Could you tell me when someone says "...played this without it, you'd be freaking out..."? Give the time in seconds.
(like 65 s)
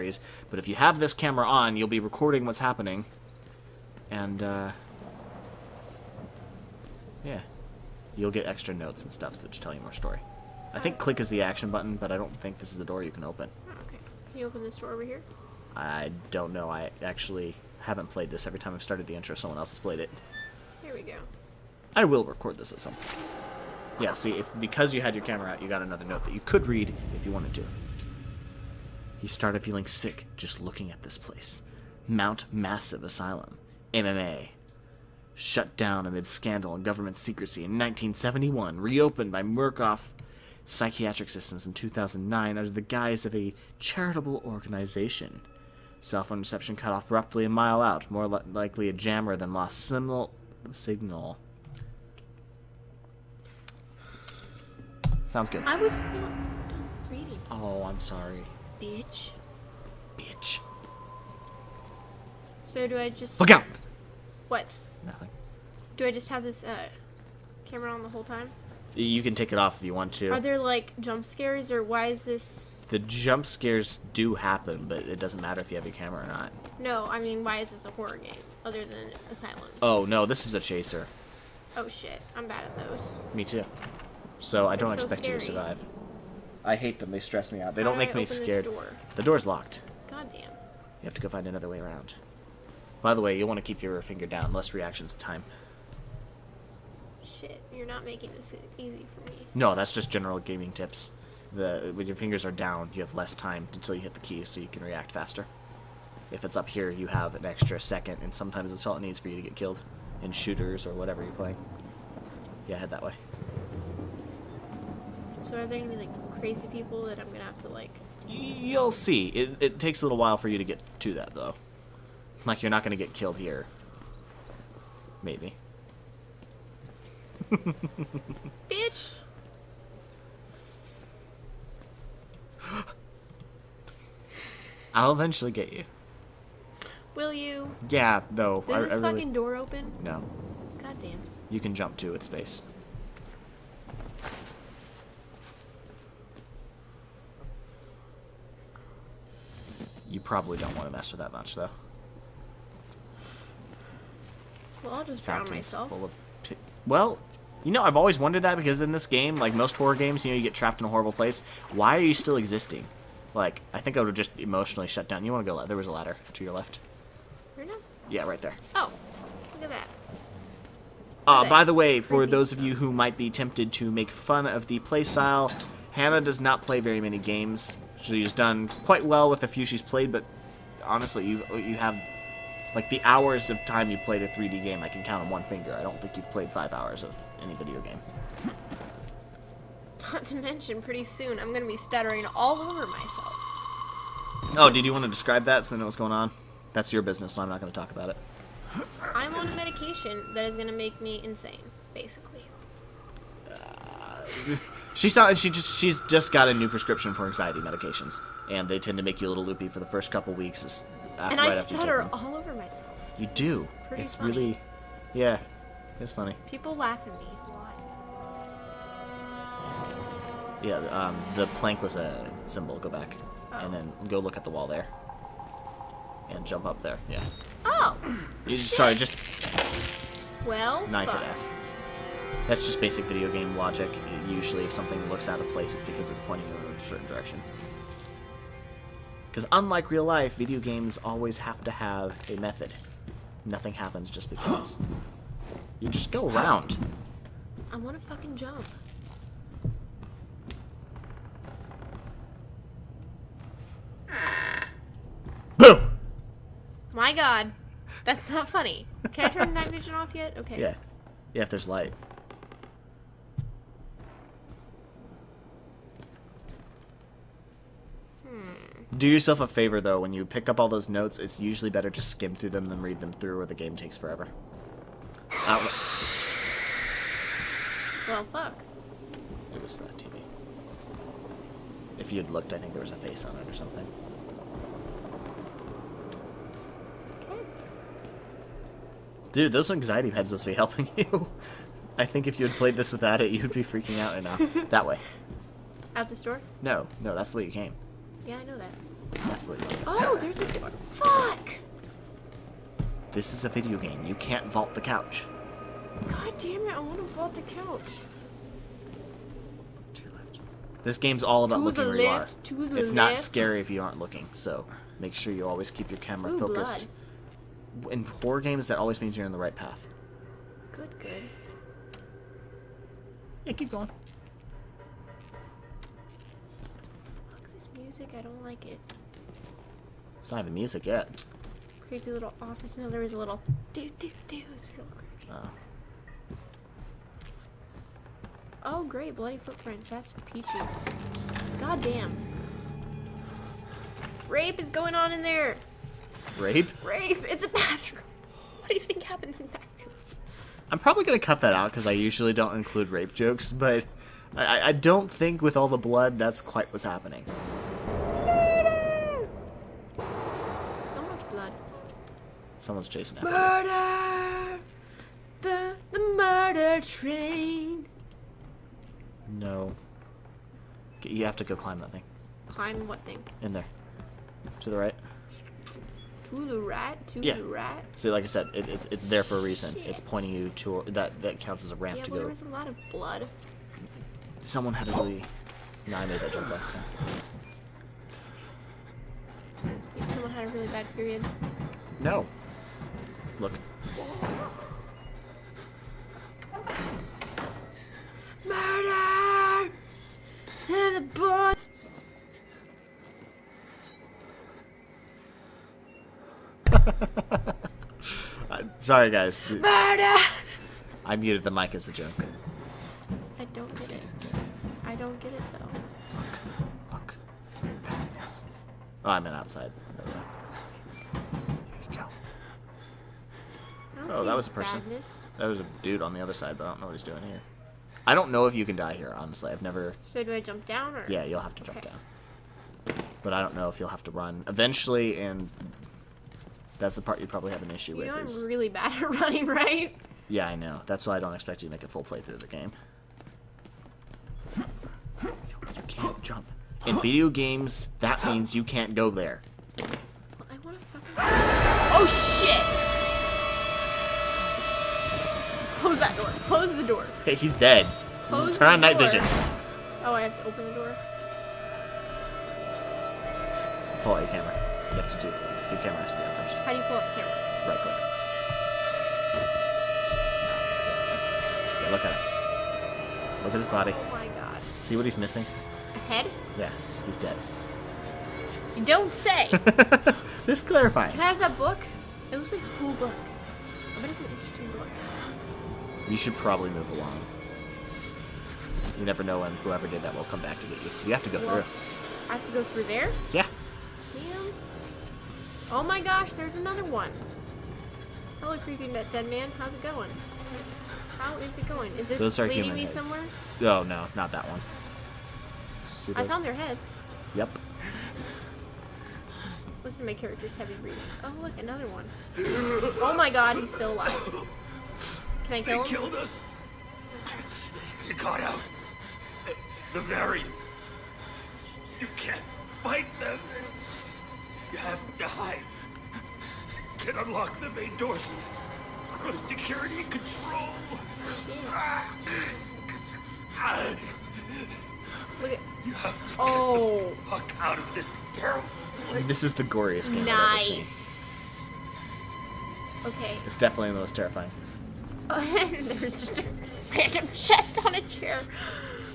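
292 s.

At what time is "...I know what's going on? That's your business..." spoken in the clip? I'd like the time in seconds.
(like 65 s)
195 s.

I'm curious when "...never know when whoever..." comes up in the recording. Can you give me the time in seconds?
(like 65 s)
489 s.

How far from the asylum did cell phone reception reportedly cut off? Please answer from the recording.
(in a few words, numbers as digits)
a mile.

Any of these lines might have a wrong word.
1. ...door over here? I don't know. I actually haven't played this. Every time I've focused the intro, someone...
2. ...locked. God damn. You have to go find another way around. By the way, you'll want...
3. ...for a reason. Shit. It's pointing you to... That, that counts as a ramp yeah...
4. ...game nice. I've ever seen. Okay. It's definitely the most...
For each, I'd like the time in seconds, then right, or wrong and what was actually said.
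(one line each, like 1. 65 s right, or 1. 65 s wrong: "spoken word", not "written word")
1. 14 s wrong: "started", not "focused"
2. 89 s right
3. 379 s right
4. 540 s right.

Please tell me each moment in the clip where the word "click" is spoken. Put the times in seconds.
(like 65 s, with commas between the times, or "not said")
10 s, 467 s.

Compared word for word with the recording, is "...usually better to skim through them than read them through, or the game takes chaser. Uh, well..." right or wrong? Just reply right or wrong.
wrong.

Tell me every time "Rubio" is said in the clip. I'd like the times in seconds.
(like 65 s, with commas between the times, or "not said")
not said.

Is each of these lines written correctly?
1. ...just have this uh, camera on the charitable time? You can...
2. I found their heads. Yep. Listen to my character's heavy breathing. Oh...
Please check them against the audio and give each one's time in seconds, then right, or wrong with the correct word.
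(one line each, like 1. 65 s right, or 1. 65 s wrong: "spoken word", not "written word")
1. 66 s wrong: "whole", not "charitable"
2. 506 s right.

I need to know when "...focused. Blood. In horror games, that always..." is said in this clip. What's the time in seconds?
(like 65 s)
316 s.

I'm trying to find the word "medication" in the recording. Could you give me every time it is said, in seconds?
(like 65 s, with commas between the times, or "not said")
199 s, 207 s.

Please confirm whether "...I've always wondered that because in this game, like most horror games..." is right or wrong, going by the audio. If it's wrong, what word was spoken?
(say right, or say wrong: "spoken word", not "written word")
right.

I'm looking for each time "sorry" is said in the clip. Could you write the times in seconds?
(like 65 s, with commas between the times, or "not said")
57 s, 228 s, 408 s.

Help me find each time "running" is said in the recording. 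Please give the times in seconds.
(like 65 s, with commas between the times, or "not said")
439 s.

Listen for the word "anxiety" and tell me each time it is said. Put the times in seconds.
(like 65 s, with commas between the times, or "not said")
207 s, 289 s.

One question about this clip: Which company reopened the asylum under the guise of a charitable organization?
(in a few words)
Murkoff Psychiatric Systems.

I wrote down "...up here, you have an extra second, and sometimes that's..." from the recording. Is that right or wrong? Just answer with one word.
right.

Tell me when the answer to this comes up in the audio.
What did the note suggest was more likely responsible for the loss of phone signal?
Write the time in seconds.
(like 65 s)
48 s.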